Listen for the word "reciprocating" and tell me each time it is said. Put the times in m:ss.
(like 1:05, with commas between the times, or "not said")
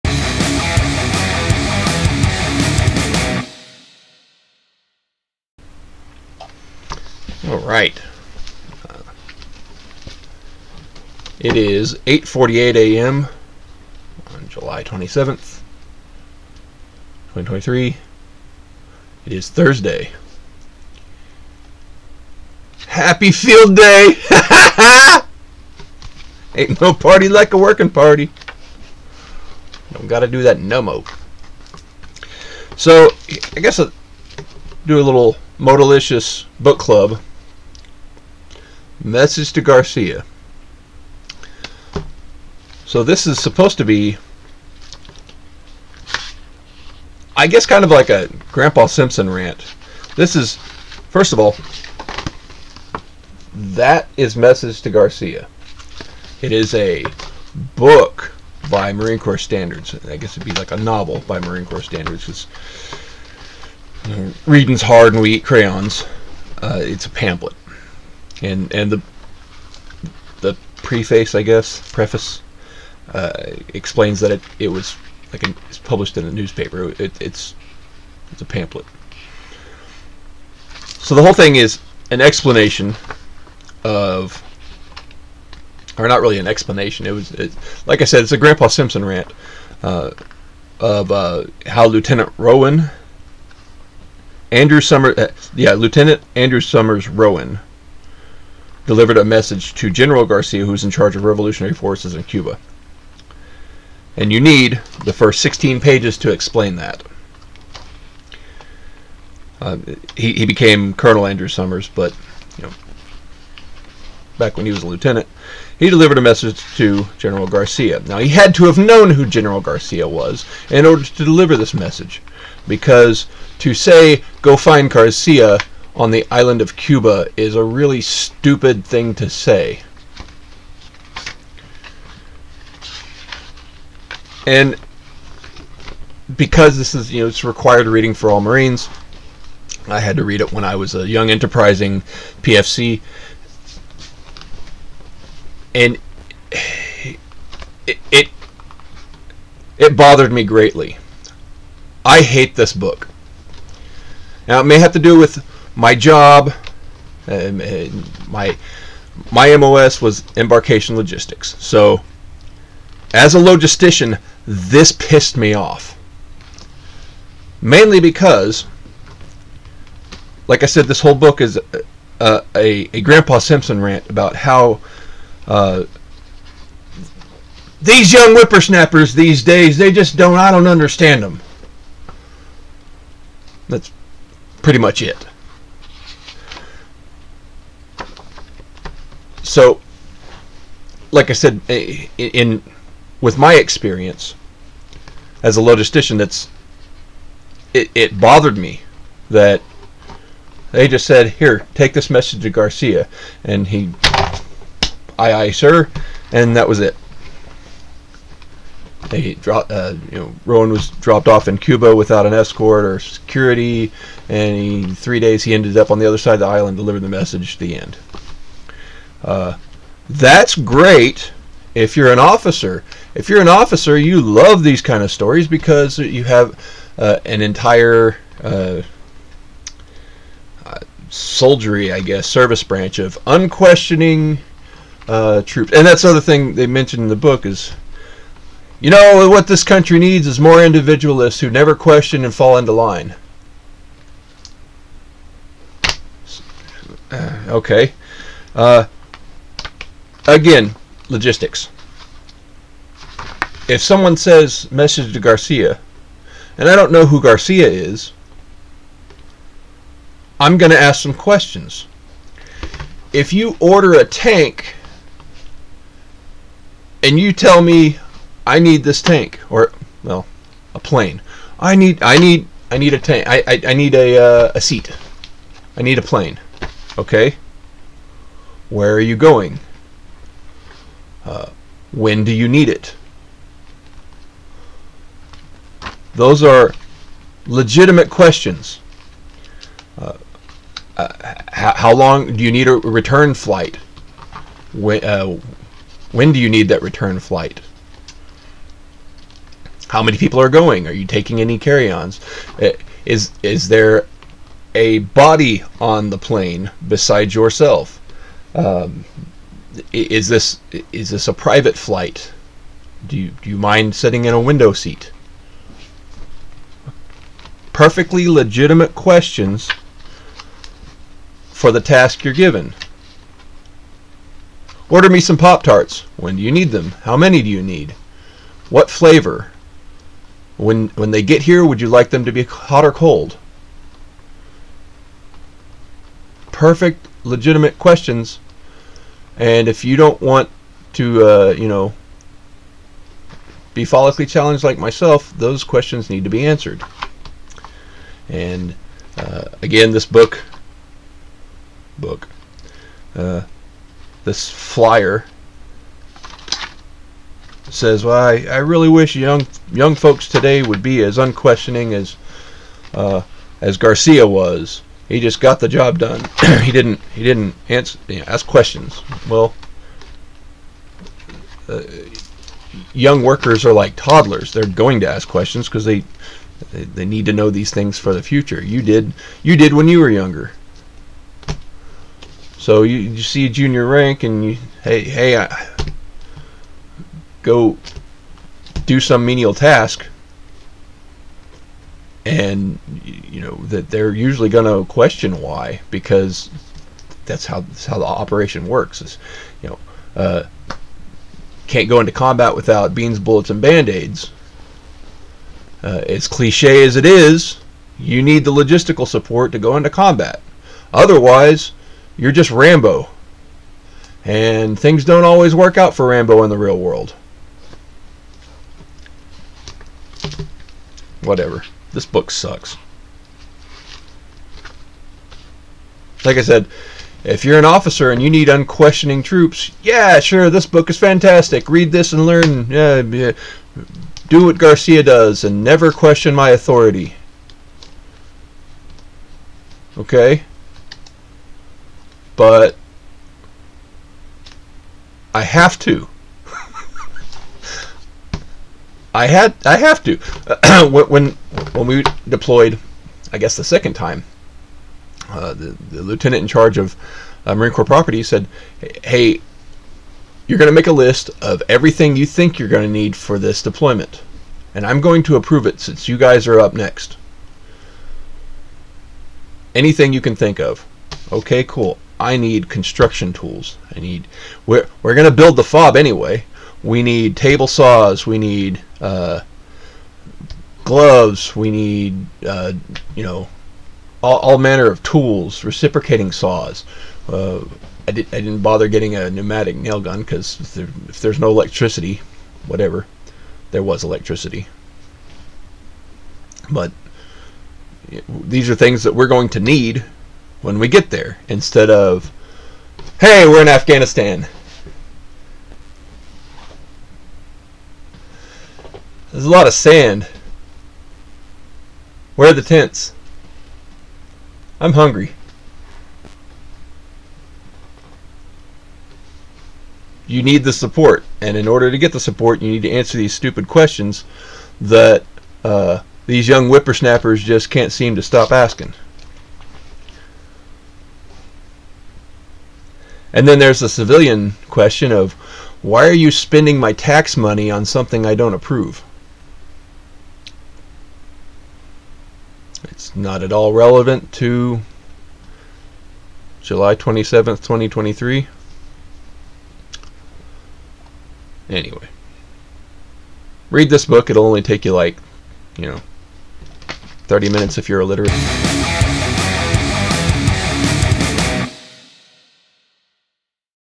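8:05.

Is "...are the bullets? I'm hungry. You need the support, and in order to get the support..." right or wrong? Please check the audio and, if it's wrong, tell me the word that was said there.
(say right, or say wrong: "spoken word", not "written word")
wrong: "tents", not "bullets".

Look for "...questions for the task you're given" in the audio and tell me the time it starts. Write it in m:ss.
5:18.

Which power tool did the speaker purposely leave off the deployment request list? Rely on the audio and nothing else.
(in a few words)
pneumatic nail gun.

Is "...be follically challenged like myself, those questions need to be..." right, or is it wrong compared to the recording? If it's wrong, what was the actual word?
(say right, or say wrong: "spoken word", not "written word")
right.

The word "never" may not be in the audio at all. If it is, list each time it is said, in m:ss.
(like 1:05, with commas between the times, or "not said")
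4:01, 7:15.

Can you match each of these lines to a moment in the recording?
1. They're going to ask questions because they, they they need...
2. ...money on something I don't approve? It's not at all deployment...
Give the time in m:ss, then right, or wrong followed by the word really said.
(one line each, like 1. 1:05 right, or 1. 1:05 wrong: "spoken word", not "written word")
1. 6:14 right
2. 8:57 wrong: "relevant", not "deployment".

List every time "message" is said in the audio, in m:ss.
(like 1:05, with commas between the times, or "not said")
0:39, 0:54, 1:39, 1:56, 2:01, 3:22, 3:37, 4:14.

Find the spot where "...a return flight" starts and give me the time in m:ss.
4:52.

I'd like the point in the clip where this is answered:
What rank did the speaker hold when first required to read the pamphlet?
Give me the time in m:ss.
2:22.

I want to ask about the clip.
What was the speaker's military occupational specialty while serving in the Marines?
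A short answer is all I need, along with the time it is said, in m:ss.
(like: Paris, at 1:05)
embarkation logistics, at 2:40.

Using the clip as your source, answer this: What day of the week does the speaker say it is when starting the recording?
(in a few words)
Thursday.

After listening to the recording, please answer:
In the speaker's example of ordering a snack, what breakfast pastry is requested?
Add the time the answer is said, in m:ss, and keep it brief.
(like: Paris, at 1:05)
Pop Tarts, at 5:25.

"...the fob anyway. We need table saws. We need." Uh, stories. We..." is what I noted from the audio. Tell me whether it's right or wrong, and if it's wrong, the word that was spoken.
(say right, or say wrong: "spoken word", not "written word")
wrong: "gloves", not "stories".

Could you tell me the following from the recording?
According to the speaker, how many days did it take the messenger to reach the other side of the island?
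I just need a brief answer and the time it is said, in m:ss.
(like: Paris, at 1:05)
3, at 3:34.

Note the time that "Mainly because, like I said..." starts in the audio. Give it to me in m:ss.
2:47.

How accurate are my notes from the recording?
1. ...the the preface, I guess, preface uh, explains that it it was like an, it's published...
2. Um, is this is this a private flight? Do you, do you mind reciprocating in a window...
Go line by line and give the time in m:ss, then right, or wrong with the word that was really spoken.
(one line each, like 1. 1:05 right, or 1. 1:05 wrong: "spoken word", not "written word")
1. 1:08 right
2. 5:08 wrong: "sitting", not "reciprocating".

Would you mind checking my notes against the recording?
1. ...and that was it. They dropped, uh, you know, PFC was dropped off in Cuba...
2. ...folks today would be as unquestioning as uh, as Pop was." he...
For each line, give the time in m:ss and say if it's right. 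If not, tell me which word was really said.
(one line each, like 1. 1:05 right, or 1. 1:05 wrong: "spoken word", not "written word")
1. 3:26 wrong: "Rowan", not "PFC"
2. 5:59 wrong: "Garcia", not "Pop".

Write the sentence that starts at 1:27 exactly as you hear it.
It was it, like I said, it's a Grandpa Simpson rant uh, of uh, how Lieutenant Rowan.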